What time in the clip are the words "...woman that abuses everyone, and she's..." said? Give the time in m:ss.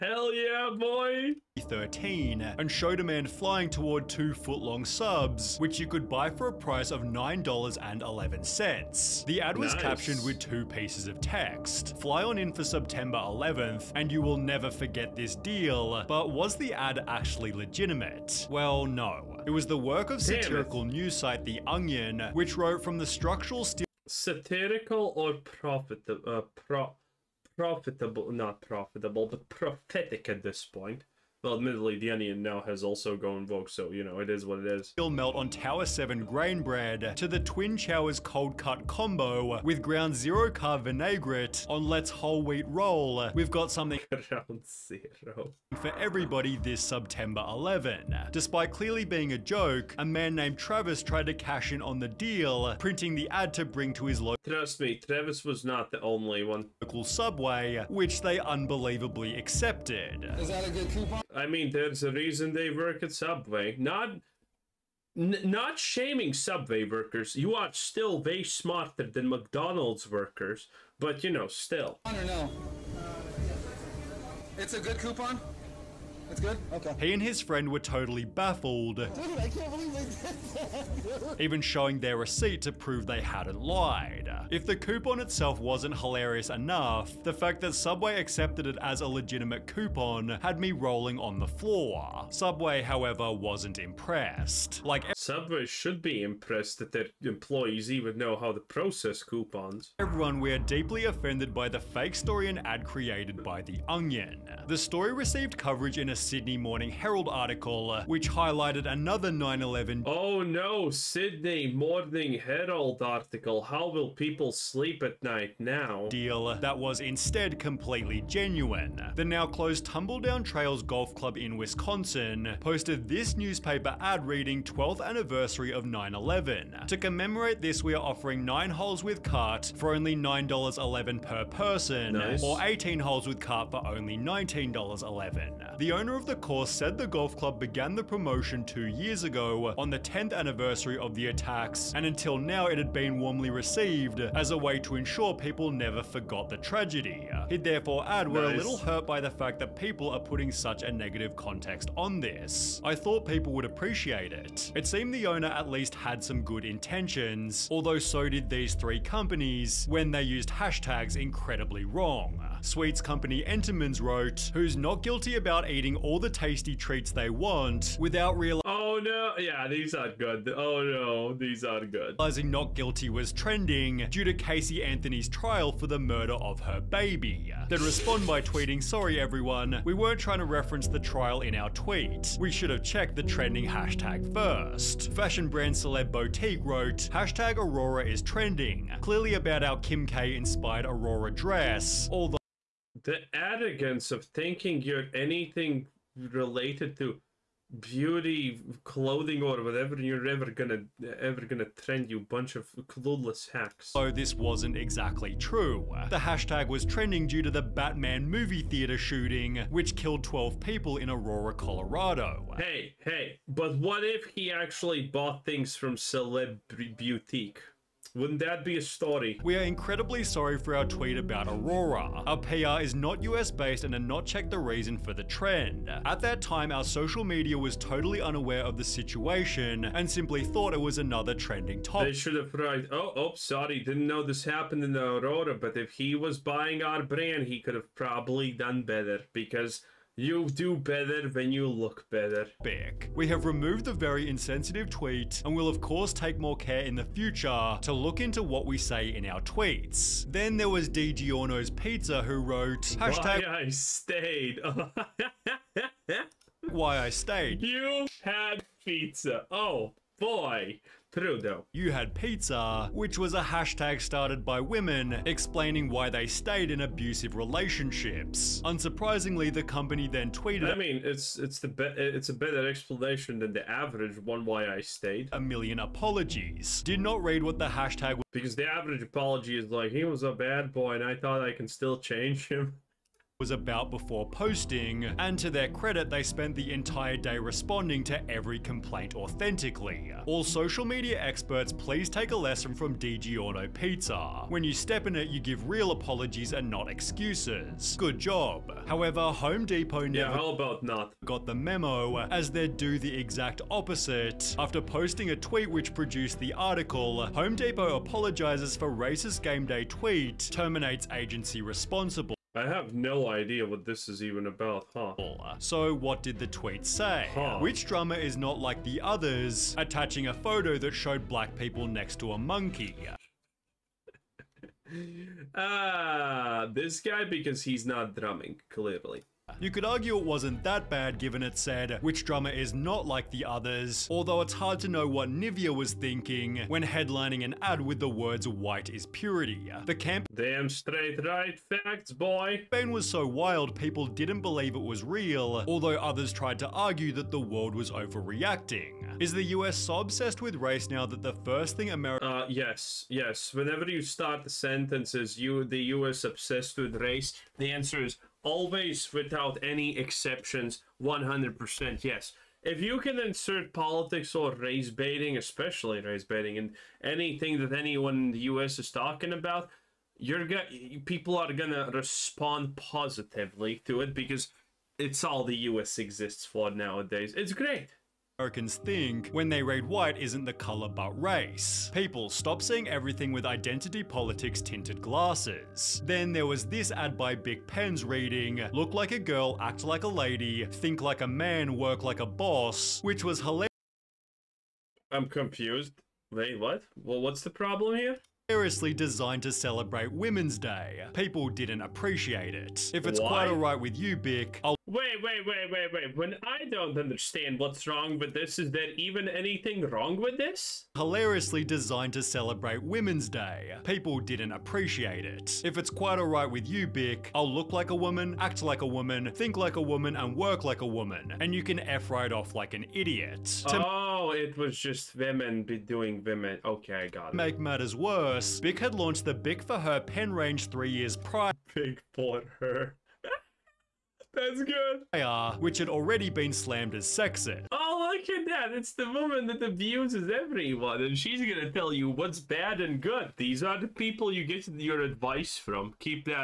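7:19.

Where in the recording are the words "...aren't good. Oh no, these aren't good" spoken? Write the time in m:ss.
2:49.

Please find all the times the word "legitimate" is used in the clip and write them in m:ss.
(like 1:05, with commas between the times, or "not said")
0:17, 1:29.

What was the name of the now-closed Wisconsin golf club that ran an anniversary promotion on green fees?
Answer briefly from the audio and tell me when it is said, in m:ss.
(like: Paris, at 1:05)
Tumbledown Trails Golf Club, at 1:59.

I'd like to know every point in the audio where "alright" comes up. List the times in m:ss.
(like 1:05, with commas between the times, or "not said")
6:43, 6:56.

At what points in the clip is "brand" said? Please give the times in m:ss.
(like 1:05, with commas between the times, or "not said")
3:05, 3:57.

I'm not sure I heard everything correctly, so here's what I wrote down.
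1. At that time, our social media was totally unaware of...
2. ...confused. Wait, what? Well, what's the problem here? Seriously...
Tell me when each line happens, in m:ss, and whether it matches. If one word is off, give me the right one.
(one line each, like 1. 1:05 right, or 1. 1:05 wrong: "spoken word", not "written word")
1. 3:46 right
2. 6:35 right.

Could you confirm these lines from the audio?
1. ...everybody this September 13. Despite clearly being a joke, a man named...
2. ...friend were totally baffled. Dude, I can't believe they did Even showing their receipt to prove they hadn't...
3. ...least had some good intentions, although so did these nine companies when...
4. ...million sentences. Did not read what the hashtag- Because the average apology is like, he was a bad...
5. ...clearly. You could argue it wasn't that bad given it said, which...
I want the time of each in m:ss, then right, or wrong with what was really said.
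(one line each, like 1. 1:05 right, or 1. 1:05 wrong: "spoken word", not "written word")
1. 0:45 wrong: "11", not "13"
2. 1:17 right
3. 2:35 wrong: "three", not "nine"
4. 4:35 wrong: "apologies", not "sentences"
5. 5:28 right.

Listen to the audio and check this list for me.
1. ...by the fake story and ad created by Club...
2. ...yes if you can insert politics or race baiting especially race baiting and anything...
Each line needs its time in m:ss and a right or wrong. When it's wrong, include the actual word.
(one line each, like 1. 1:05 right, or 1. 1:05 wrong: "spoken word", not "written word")
1. 1:41 wrong: "The", not "Club"
2. 6:02 right.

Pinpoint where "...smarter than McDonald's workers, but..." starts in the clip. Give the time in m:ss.
1:08.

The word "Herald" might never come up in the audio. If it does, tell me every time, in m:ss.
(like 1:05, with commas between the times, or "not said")
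1:46, 1:52.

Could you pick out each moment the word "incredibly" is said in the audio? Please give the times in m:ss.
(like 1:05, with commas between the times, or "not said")
2:41, 3:39.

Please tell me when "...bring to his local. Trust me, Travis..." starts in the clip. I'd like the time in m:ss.
0:53.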